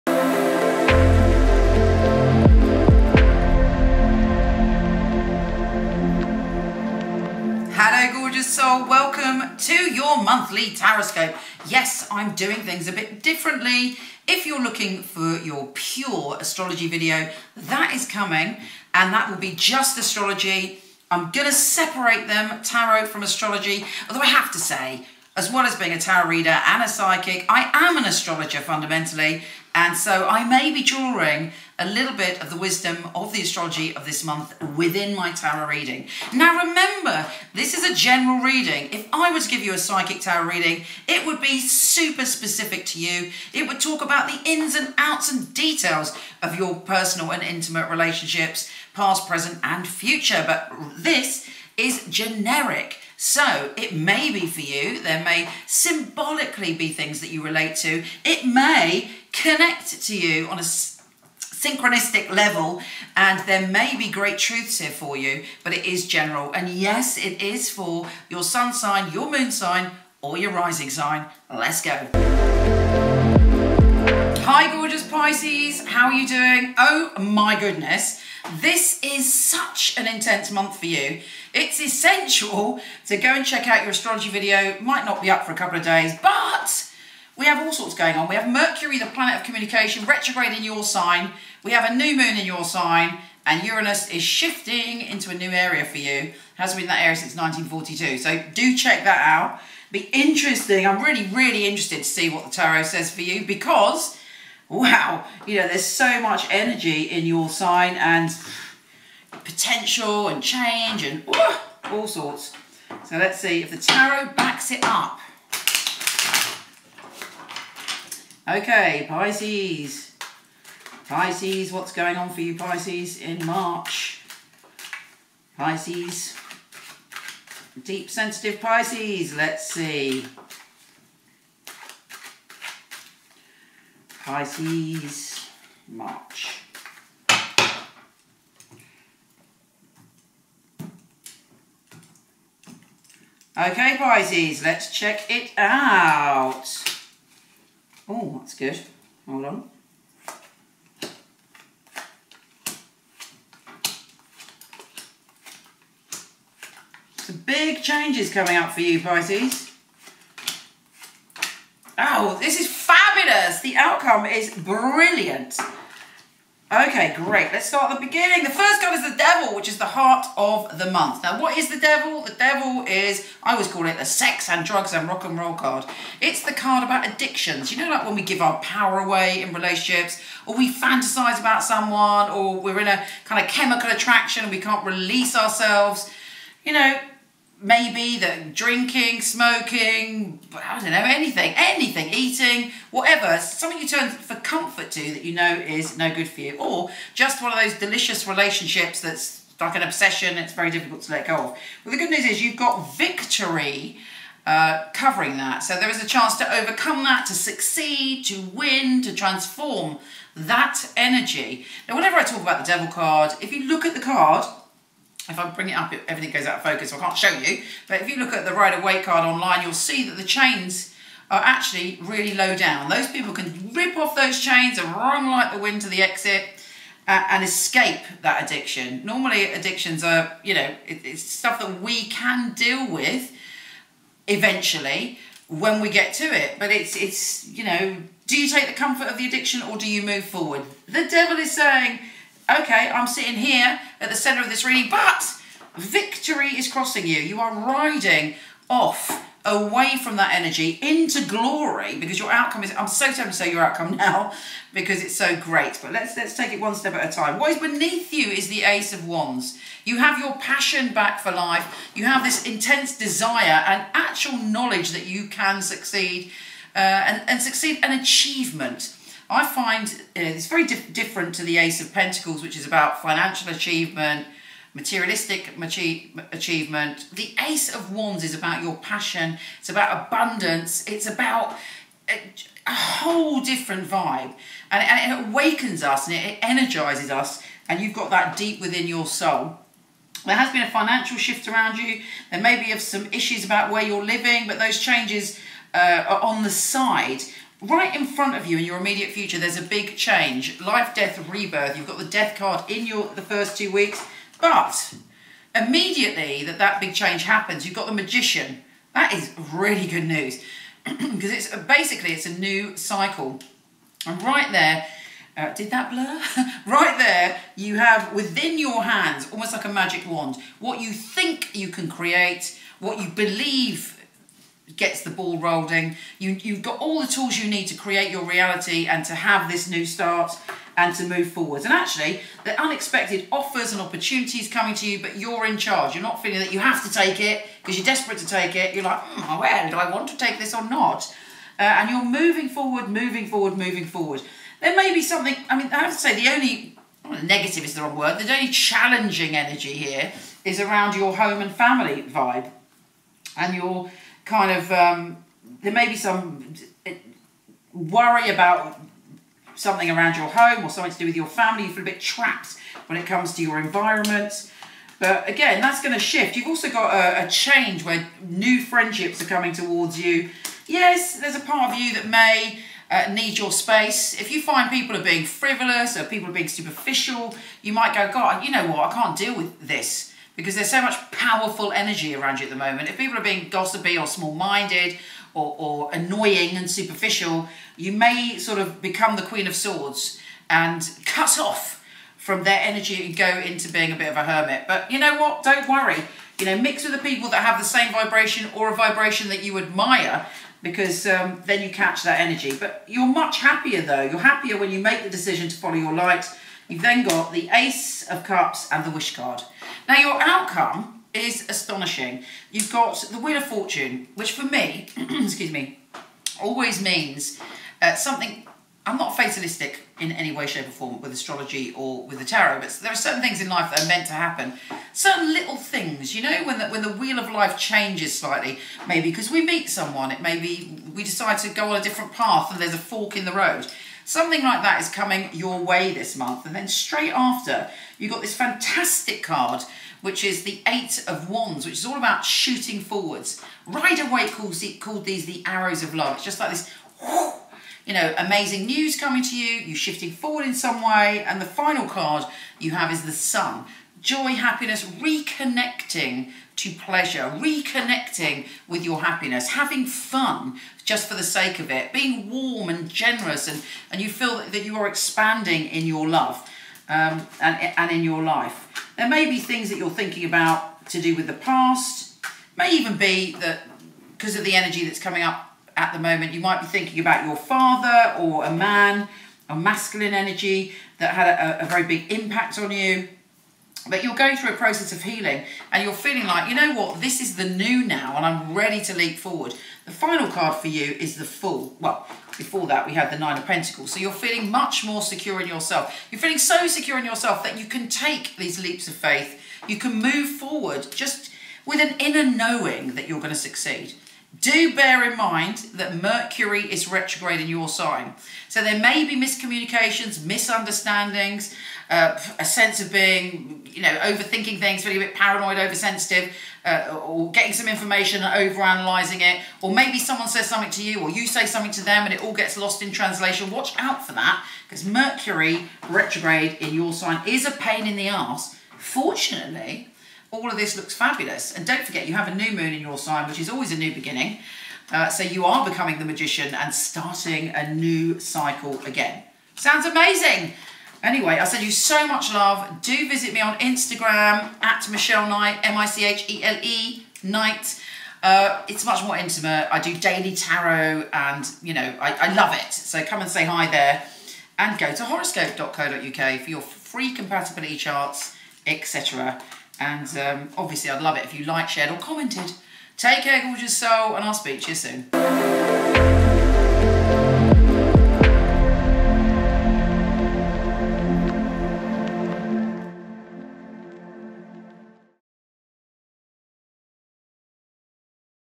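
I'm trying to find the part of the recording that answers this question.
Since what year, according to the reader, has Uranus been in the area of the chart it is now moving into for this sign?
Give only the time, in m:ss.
1:37.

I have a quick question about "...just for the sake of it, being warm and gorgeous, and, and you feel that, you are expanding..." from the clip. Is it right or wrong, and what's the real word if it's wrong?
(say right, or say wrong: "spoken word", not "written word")
wrong: "generous", not "gorgeous".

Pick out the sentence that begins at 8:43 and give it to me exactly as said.
Watch out for that because Mercury retrograde in your sign is a pain in the ass.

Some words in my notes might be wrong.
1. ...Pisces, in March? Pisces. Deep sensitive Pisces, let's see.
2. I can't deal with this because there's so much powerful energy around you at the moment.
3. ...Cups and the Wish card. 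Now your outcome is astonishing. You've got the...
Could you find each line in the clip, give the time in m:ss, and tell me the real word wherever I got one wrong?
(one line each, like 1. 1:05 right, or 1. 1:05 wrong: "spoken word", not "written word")
1. 2:02 right
2. 6:18 right
3. 6:48 right.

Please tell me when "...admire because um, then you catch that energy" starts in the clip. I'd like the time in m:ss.
6:39.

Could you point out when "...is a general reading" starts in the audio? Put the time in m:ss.
0:37.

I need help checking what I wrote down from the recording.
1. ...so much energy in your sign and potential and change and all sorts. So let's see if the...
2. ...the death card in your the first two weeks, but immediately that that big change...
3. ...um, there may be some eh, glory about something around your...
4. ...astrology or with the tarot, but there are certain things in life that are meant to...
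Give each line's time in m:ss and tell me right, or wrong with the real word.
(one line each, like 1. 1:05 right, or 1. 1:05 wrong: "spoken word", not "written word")
1. 1:45 right
2. 5:01 right
3. 5:54 wrong: "worry", not "glory"
4. 7:01 right.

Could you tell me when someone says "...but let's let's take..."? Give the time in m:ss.
4:15.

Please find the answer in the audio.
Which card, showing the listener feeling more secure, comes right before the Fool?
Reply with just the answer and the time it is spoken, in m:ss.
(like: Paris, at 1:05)
Nine of Pentacles, at 8:13.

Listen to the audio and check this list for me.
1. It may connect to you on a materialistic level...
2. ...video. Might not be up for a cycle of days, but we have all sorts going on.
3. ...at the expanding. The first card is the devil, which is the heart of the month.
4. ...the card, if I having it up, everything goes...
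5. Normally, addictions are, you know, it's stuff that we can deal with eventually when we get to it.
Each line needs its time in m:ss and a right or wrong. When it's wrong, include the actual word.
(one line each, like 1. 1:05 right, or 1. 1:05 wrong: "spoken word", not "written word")
1. 0:58 wrong: "synchronistic", not "materialistic"
2. 1:24 wrong: "couple", not "cycle"
3. 2:47 wrong: "beginning", not "expanding"
4. 3:33 wrong: "bring", not "having"
5. 3:49 right.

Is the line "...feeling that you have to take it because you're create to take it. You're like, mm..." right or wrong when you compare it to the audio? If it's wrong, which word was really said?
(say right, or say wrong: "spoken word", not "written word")
wrong: "desperate", not "create".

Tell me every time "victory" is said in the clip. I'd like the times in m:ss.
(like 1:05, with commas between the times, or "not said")
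3:22, 4:05.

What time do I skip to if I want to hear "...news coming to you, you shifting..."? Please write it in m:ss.
7:28.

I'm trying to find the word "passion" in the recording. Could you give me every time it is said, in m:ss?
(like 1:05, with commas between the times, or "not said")
4:20, 4:38.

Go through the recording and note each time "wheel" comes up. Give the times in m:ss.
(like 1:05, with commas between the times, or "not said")
6:53, 7:06.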